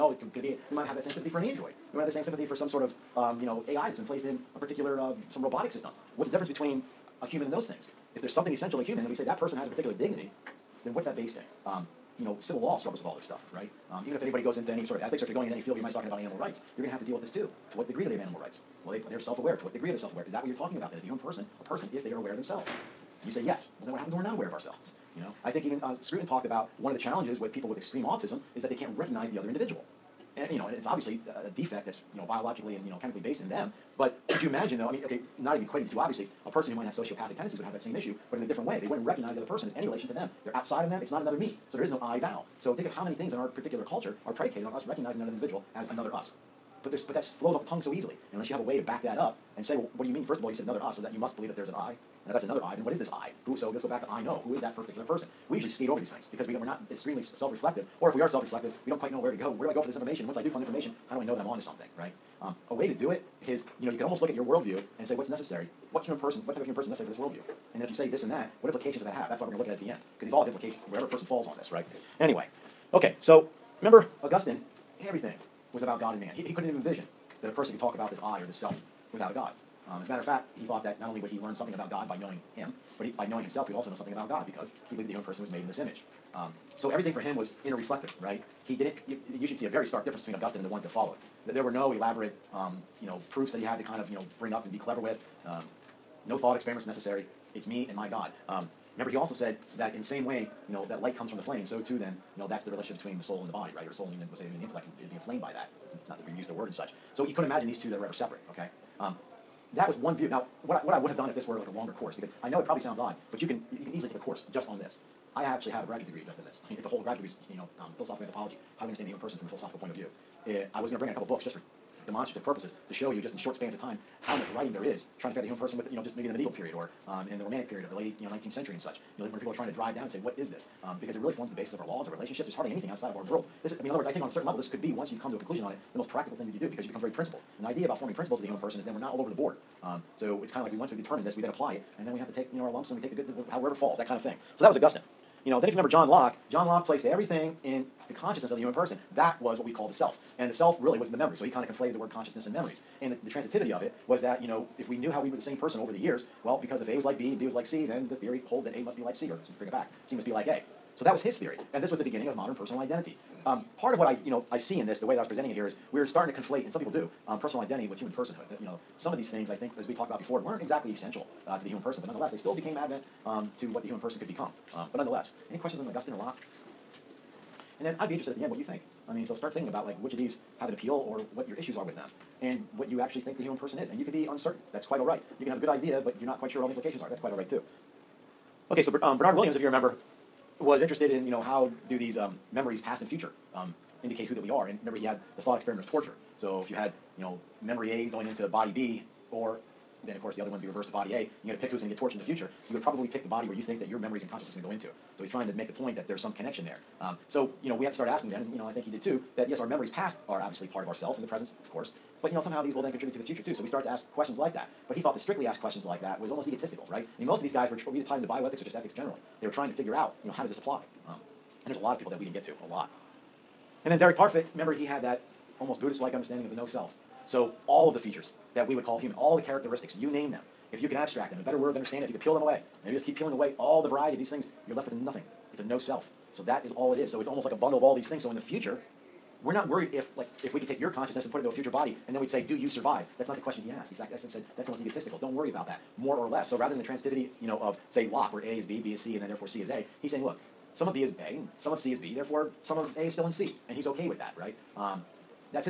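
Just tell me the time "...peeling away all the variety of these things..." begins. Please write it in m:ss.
3:53.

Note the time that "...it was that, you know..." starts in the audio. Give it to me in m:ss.
2:33.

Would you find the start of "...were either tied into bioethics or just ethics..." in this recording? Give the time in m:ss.
3:37.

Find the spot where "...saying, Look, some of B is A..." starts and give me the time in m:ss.
4:10.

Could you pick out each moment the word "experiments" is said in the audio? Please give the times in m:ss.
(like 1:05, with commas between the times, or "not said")
1:36, 3:15.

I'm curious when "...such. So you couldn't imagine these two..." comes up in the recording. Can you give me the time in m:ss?
1:46.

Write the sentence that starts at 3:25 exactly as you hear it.
So he's trying to make the point that there's some connection there.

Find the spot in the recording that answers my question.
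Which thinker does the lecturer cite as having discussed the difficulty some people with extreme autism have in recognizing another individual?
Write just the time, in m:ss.
0:26.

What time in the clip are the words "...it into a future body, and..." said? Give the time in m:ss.
4:01.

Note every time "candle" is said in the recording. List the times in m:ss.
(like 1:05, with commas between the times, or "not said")
not said.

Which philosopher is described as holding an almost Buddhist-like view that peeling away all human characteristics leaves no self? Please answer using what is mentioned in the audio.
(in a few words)
Derek Parfit.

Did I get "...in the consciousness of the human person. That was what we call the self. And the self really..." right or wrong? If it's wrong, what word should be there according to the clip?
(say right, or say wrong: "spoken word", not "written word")
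right.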